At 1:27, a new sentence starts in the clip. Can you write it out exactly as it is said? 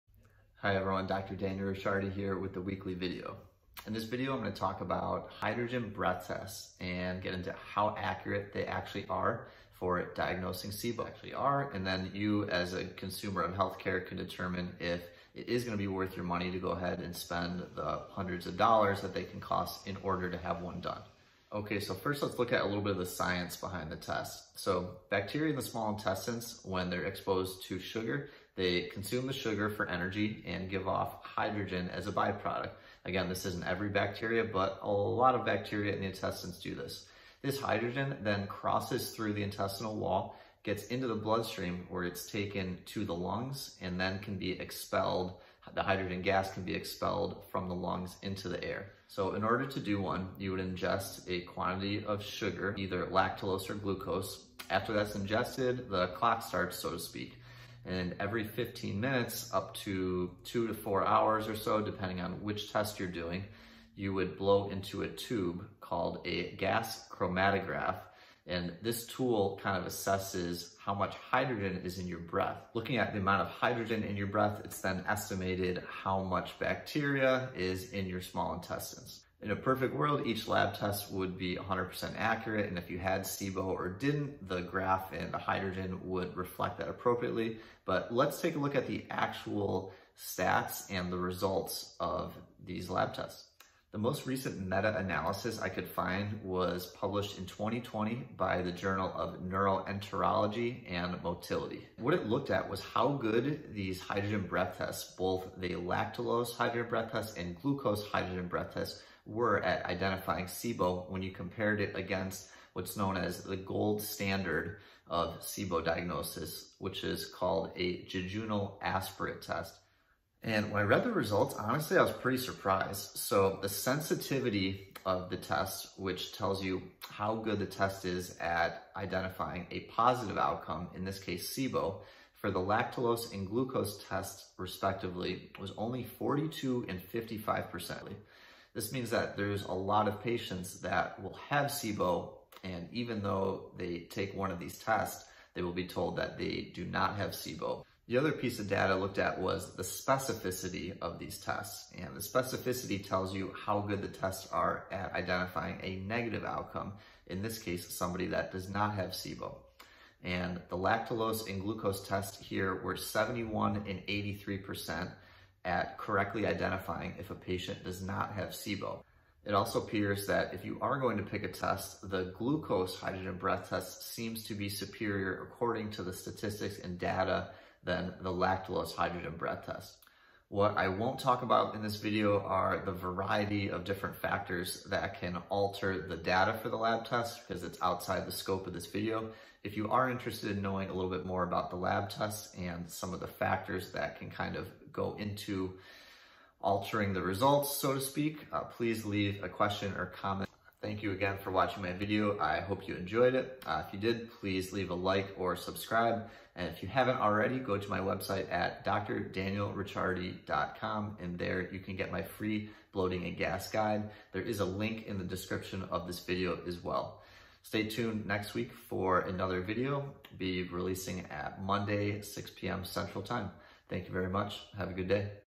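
But let's take a look at the actual stats and the results of these lab tests.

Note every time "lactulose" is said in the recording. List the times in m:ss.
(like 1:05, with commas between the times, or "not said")
0:53, 1:45, 2:12, 2:40, 2:58.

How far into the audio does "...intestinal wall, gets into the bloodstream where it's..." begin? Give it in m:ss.
0:39.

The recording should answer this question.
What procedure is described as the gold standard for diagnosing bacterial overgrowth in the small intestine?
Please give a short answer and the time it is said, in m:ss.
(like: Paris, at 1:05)
jejunal aspirate test, at 1:58.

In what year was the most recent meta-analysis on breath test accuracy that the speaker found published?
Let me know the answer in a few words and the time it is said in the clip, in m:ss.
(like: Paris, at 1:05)
2020, at 1:37.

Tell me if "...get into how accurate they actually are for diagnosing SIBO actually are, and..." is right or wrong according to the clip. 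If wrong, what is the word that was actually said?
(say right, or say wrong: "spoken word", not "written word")
right.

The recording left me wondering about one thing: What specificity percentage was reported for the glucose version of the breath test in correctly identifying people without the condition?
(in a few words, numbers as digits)
83%.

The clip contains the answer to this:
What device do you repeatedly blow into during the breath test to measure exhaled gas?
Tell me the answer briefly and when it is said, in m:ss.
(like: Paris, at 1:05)
gas chromatograph, at 1:06.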